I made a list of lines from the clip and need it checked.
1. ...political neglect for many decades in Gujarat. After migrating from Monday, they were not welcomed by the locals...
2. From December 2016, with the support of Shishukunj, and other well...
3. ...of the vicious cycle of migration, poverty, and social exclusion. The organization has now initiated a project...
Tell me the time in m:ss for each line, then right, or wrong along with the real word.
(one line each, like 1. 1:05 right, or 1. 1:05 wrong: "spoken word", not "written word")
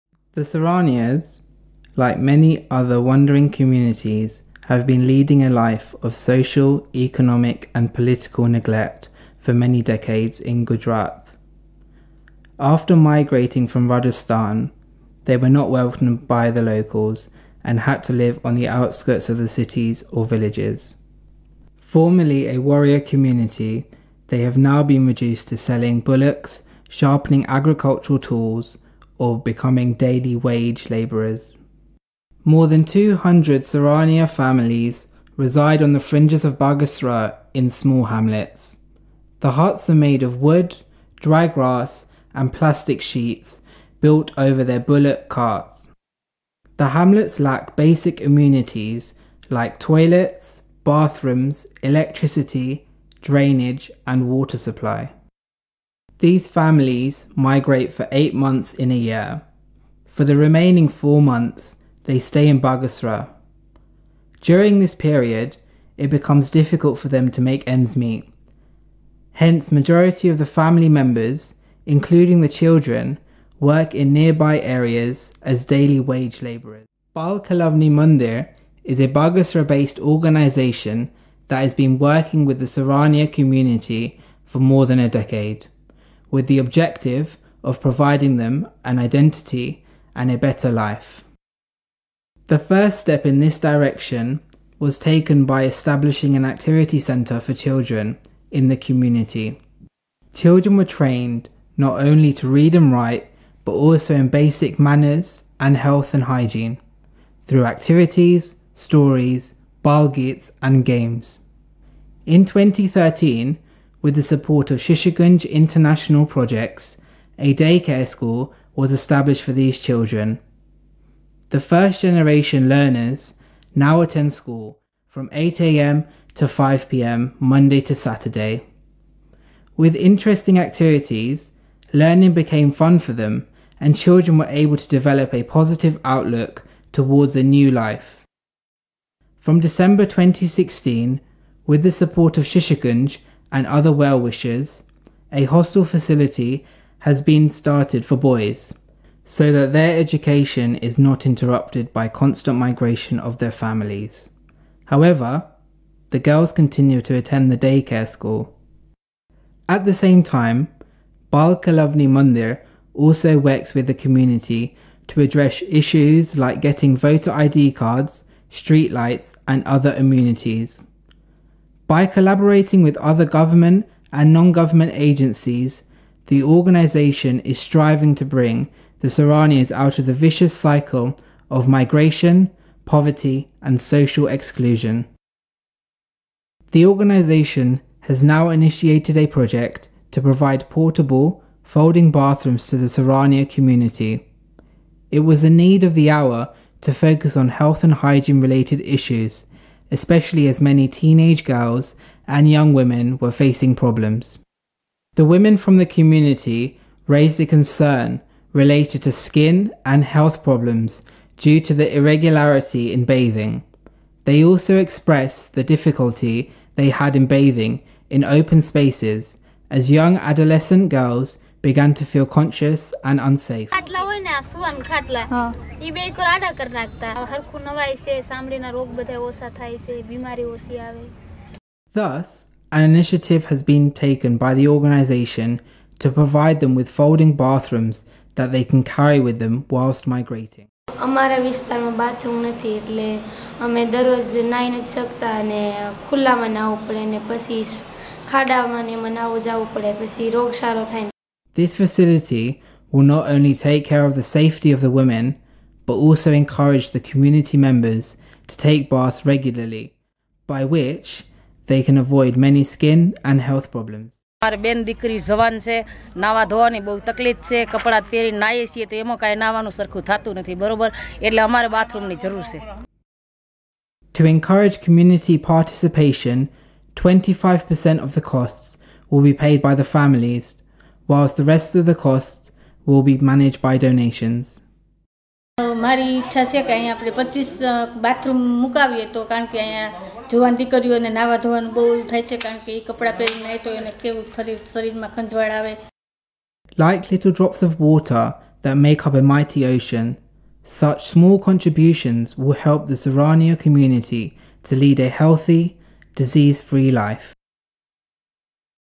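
1. 0:07 wrong: "Rajasthan", not "Monday"
2. 2:19 right
3. 2:59 right.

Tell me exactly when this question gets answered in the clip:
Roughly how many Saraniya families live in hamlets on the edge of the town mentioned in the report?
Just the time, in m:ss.
0:32.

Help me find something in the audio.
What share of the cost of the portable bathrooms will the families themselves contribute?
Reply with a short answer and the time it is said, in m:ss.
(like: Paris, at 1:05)
25%, at 4:37.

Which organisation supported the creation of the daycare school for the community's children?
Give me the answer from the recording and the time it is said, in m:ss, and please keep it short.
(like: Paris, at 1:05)
Shishukunj International Projects, at 1:54.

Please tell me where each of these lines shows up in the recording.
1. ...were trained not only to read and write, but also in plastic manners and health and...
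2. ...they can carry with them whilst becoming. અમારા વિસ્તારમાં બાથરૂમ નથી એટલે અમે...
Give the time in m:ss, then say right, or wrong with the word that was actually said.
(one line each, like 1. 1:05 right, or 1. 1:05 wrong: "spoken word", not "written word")
1. 1:40 wrong: "basic", not "plastic"
2. 3:58 wrong: "migrating", not "becoming".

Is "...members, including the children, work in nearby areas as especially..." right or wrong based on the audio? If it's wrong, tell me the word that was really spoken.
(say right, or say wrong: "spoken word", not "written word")
wrong: "daily", not "especially".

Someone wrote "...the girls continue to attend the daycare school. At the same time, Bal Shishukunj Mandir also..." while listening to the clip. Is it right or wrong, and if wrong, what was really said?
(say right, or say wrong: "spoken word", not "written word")
wrong: "Kelavani", not "Shishukunj".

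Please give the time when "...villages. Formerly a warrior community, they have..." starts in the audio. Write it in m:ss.
0:20.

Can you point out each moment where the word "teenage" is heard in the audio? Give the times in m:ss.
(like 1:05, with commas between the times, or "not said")
3:20.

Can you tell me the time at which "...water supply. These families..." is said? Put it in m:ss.
0:54.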